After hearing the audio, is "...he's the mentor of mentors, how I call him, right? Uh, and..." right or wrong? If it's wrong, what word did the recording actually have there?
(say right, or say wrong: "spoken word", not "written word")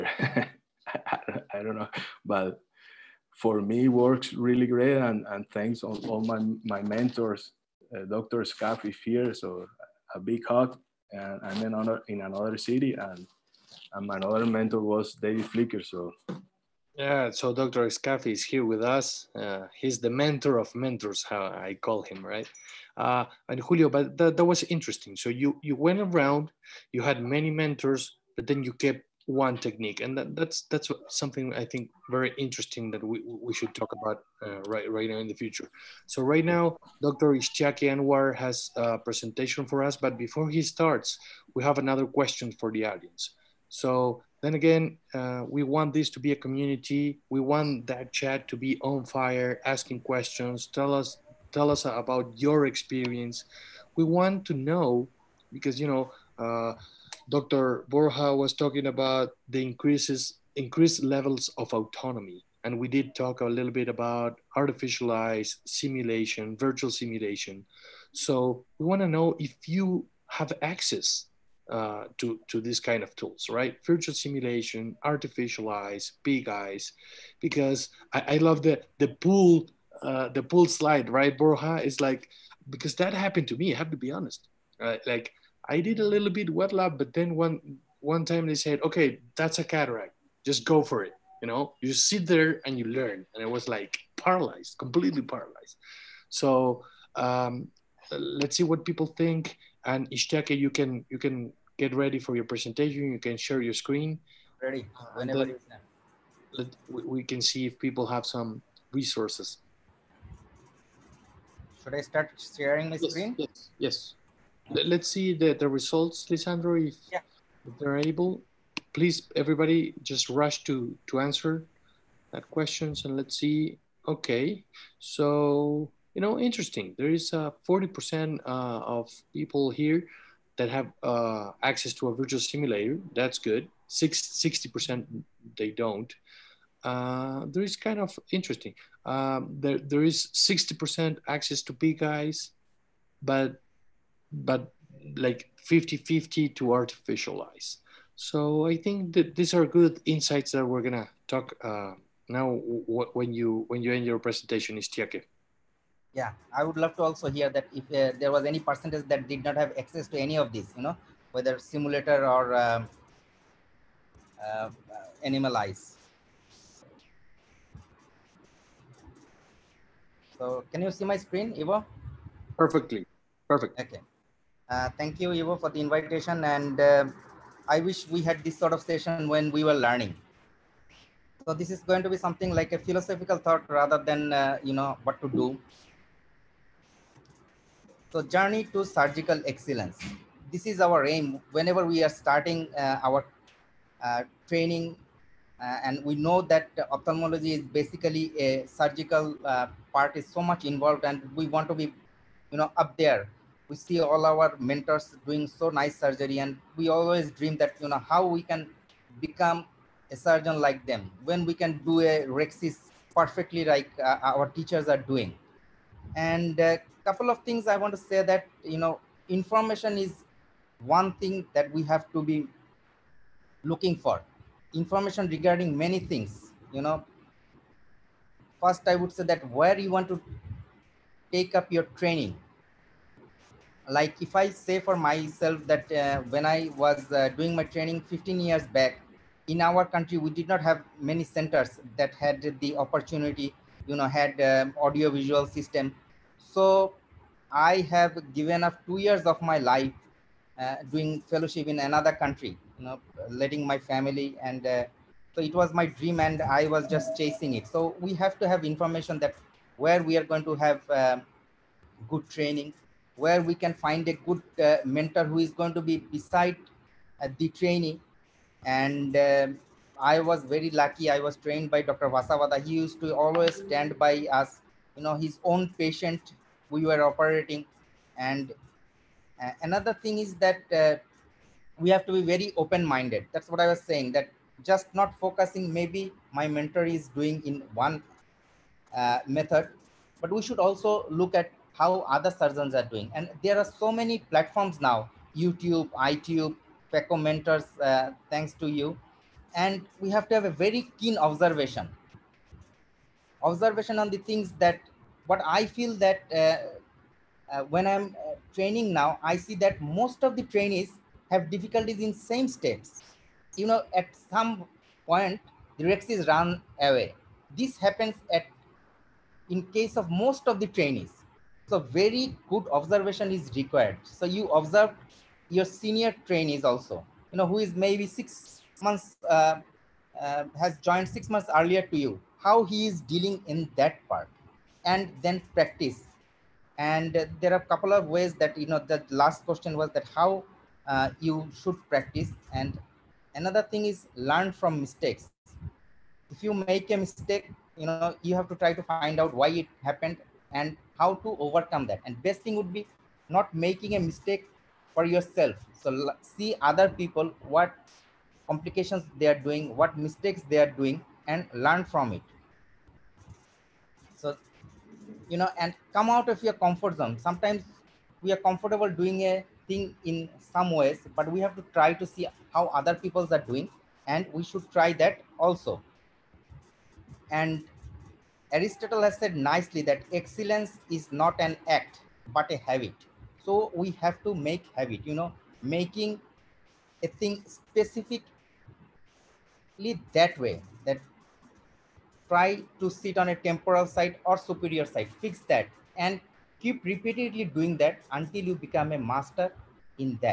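right.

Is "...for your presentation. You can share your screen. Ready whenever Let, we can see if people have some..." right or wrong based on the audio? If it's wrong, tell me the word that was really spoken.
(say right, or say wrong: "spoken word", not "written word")
right.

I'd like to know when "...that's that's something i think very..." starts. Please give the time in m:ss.
0:30.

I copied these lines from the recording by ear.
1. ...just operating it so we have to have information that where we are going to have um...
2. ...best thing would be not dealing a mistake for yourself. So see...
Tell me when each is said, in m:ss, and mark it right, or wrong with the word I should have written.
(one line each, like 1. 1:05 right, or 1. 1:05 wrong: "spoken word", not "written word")
1. 4:16 wrong: "chasing", not "operating"
2. 5:52 wrong: "making", not "dealing".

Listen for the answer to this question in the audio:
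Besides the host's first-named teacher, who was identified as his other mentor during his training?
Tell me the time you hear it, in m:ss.
0:15.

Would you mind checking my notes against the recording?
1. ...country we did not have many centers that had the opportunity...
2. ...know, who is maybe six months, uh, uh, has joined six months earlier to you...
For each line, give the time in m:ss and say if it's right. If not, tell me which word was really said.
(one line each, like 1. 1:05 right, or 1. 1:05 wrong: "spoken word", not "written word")
1. 3:59 right
2. 5:27 right.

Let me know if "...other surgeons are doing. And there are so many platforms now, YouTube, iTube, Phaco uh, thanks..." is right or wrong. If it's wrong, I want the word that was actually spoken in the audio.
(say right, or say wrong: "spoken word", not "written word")
right.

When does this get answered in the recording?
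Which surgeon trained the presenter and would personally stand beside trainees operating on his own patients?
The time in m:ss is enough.
4:32.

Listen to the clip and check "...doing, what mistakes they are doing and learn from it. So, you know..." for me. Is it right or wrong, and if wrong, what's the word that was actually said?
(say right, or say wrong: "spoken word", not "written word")
right.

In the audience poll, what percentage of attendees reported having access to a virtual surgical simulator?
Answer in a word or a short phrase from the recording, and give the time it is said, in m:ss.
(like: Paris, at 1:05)
40%, at 2:07.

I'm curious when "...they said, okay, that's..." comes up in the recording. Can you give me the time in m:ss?
1:28.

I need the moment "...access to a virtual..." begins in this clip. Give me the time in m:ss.
2:11.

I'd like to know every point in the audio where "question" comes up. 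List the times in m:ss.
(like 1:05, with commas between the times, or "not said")
0:42, 0:50, 2:02, 5:39.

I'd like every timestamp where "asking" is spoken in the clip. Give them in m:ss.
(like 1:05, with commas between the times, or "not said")
0:49.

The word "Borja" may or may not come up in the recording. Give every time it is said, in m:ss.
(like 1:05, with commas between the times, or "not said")
0:57, 1:21.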